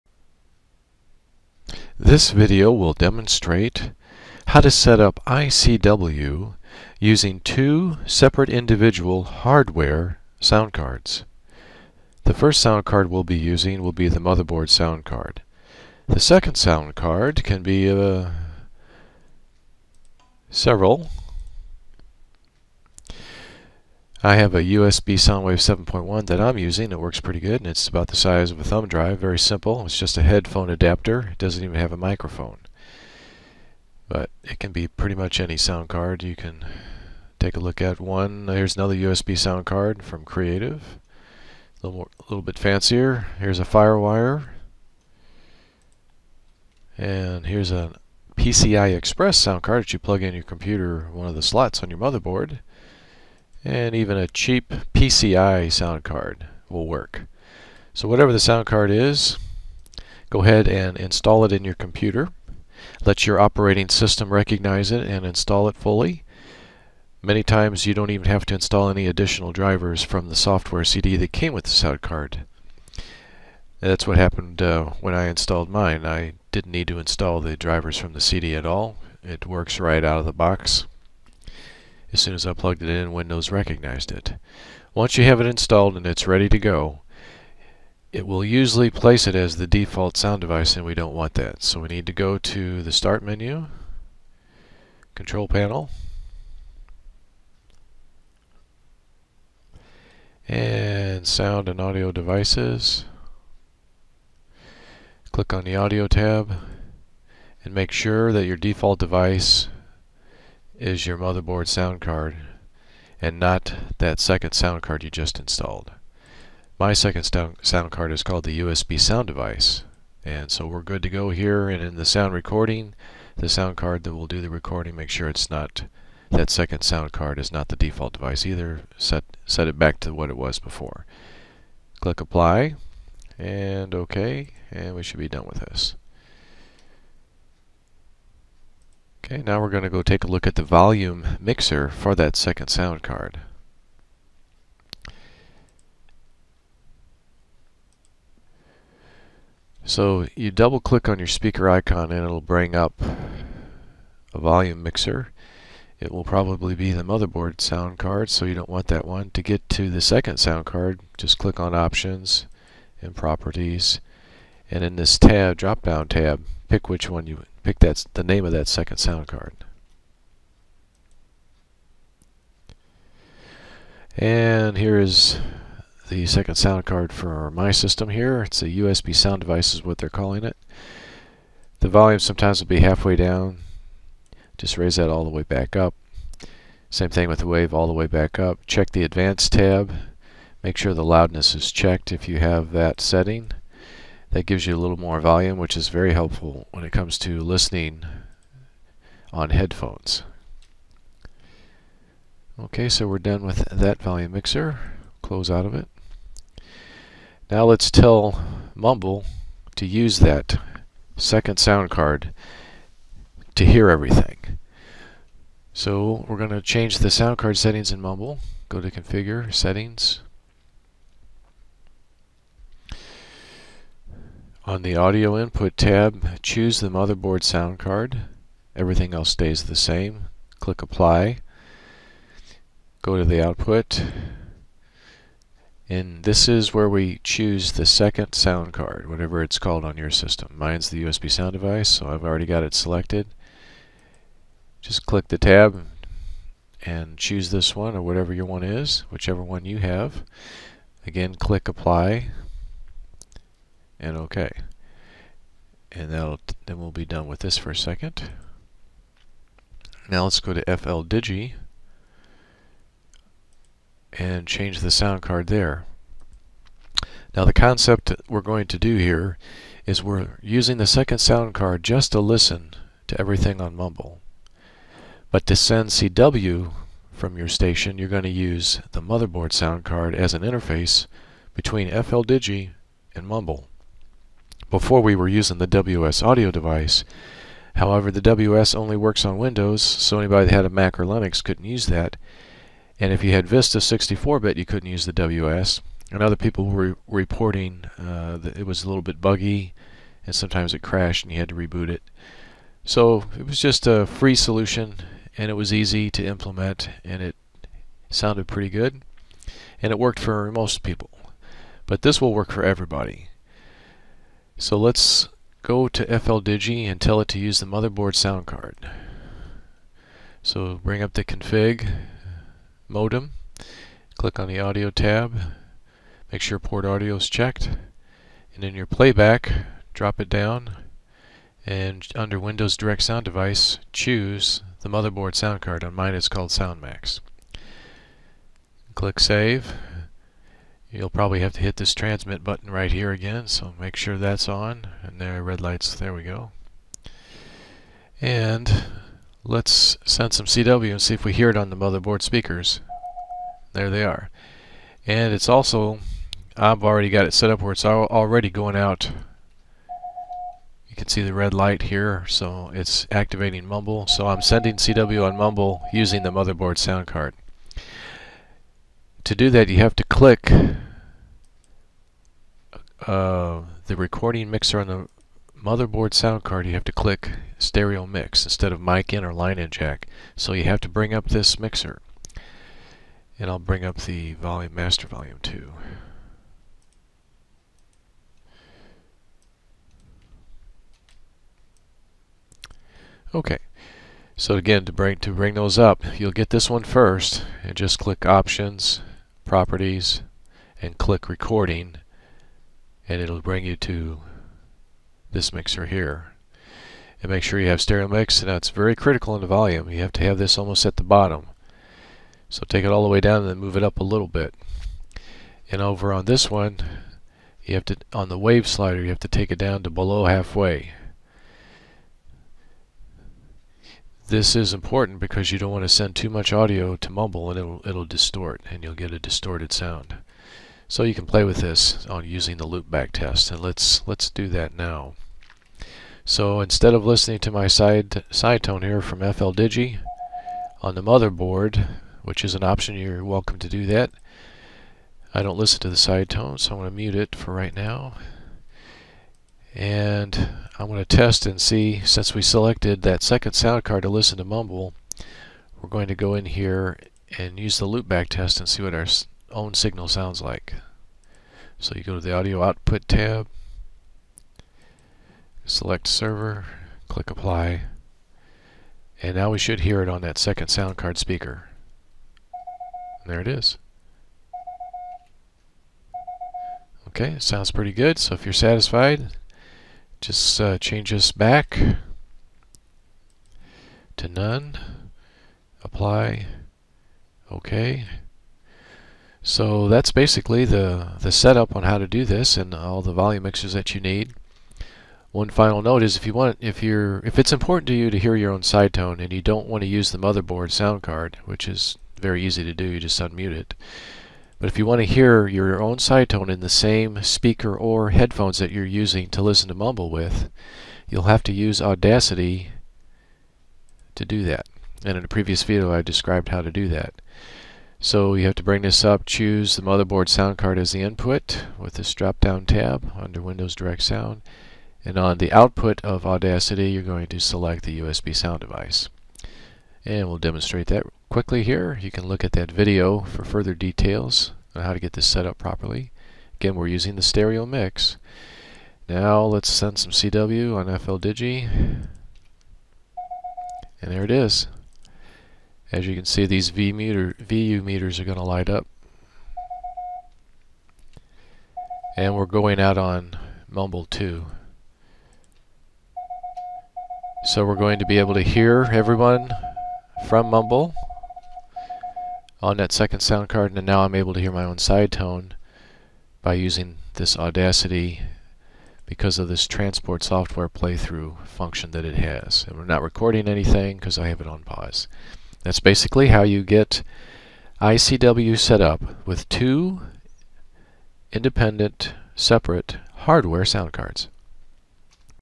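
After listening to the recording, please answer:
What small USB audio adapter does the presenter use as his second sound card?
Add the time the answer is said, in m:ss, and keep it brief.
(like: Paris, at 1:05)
USB Soundwave 7.1, at 0:24.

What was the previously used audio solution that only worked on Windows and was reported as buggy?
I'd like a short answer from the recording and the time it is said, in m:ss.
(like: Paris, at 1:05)
WS audio device, at 4:45.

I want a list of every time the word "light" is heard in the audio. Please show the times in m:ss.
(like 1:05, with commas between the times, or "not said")
5:45, 6:01, 9:08.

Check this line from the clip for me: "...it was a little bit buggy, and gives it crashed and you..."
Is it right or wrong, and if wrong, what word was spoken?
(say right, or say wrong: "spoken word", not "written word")
wrong: "sometimes", not "gives".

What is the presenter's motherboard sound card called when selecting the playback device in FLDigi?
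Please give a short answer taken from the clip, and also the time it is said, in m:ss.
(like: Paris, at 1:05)
SoundMax, at 5:36.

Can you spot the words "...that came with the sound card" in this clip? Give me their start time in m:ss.
1:11.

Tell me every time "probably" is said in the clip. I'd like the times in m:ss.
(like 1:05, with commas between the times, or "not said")
2:36, 5:41.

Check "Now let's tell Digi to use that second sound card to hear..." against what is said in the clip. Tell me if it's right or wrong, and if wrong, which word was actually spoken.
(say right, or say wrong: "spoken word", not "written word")
wrong: "Mumble", not "Digi".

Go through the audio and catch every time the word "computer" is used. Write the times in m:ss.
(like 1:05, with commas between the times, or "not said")
0:50, 1:01.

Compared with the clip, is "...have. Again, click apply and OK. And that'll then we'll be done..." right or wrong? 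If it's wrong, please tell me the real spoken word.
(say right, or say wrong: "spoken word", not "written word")
right.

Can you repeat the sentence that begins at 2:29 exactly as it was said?
So you double click on your speaker icon and it'll bring up a volume mixer.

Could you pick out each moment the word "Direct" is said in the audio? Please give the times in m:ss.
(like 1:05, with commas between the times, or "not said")
5:32, 8:43.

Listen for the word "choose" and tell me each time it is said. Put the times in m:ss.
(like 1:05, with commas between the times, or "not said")
3:46, 3:57, 4:07, 5:33, 8:39.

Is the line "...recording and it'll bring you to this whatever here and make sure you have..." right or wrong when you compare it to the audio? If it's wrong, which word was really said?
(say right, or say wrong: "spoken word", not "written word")
wrong: "mixer", not "whatever".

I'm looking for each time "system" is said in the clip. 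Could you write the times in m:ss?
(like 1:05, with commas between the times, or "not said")
1:03, 2:57, 4:00.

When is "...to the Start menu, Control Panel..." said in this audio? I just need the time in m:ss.
1:32.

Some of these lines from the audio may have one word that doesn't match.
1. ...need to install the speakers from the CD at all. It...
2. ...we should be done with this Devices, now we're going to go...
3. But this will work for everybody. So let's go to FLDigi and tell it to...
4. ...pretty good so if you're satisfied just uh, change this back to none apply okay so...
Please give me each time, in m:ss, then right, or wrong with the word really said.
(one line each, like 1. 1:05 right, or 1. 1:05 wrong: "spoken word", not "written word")
1. 1:16 wrong: "drivers", not "speakers"
2. 2:14 wrong: "Okay", not "Devices"
3. 5:11 right
4. 7:57 right.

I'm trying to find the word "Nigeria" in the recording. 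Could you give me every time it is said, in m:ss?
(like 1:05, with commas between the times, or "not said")
not said.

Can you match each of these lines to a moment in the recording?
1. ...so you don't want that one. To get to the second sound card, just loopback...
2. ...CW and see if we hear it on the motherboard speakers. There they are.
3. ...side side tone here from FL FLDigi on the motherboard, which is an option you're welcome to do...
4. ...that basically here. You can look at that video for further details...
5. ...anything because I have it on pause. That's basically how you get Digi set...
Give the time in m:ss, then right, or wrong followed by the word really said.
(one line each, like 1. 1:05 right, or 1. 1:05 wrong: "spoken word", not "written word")
1. 2:38 wrong: "click", not "loopback"
2. 5:50 right
3. 7:17 wrong: "Digi", not "FLDigi"
4. 8:50 wrong: "quickly", not "basically"
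5. 9:33 wrong: "ICW", not "Digi".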